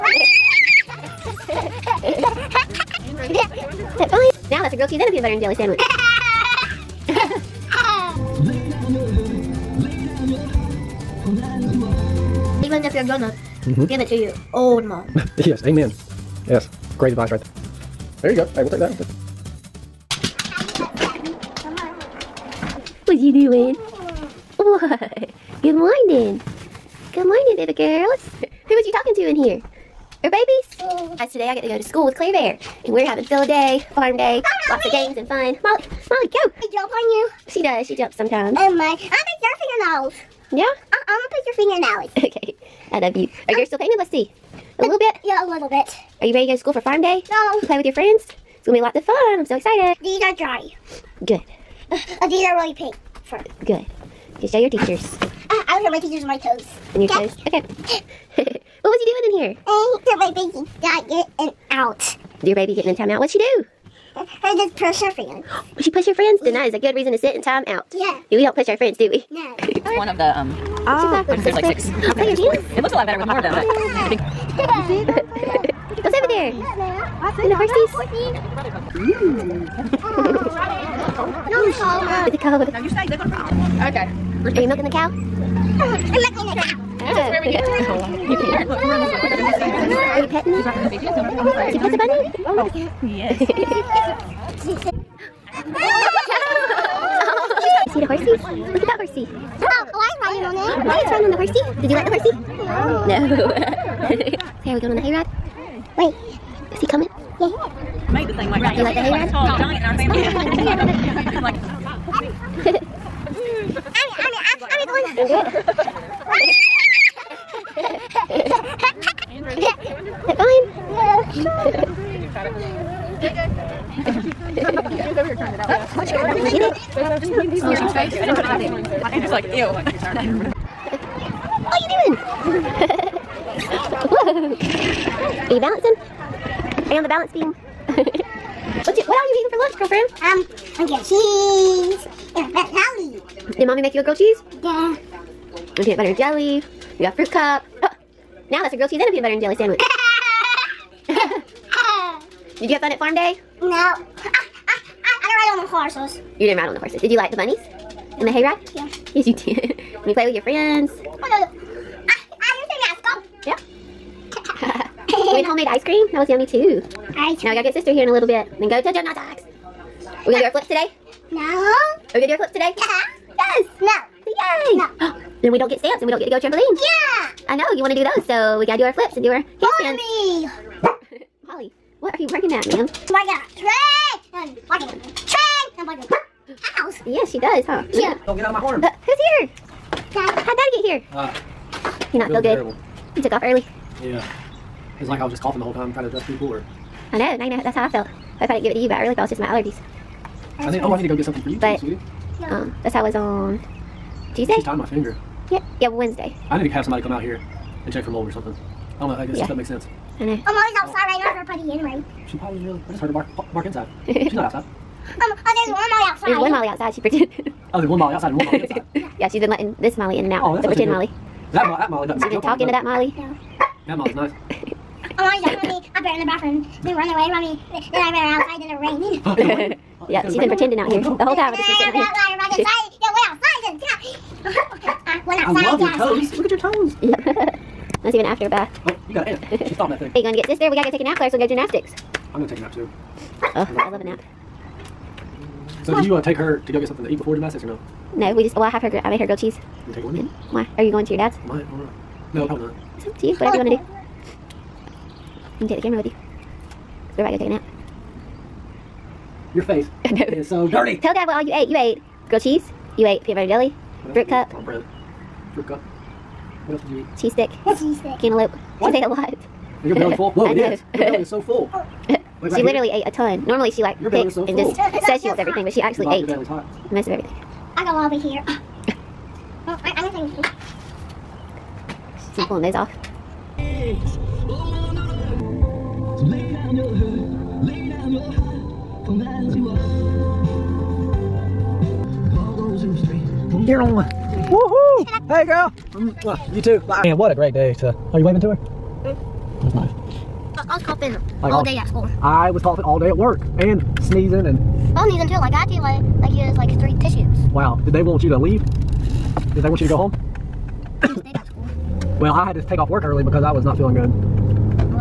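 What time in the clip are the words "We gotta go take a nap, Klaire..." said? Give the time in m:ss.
4:00.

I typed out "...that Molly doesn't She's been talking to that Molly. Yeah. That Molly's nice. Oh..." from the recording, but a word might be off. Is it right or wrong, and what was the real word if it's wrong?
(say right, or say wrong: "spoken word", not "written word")
right.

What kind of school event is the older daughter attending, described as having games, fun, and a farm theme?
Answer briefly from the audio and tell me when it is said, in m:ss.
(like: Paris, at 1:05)
Field day, at 0:33.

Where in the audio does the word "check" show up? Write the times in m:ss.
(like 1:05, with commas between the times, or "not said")
3:27.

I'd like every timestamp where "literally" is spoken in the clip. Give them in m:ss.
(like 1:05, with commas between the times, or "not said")
4:32.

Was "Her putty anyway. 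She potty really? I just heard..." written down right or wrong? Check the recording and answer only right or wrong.
right.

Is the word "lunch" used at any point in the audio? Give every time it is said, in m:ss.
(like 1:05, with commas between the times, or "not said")
2:19.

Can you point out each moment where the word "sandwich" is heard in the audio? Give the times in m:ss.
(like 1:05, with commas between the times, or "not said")
0:05, 2:29.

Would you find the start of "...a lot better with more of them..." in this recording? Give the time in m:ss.
1:12.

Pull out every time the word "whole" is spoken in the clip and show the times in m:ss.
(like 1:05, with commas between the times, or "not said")
3:15, 3:51.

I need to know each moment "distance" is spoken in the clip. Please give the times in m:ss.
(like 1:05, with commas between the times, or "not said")
not said.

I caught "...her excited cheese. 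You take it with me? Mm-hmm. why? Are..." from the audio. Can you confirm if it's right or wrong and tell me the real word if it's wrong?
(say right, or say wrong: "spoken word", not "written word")
wrong: "grilled", not "excited".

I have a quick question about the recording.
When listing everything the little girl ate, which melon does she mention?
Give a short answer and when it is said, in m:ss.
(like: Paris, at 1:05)
Cantaloupe, at 4:28.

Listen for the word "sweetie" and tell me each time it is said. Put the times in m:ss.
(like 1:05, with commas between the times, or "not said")
3:21.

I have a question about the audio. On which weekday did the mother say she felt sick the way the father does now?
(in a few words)
Tuesday.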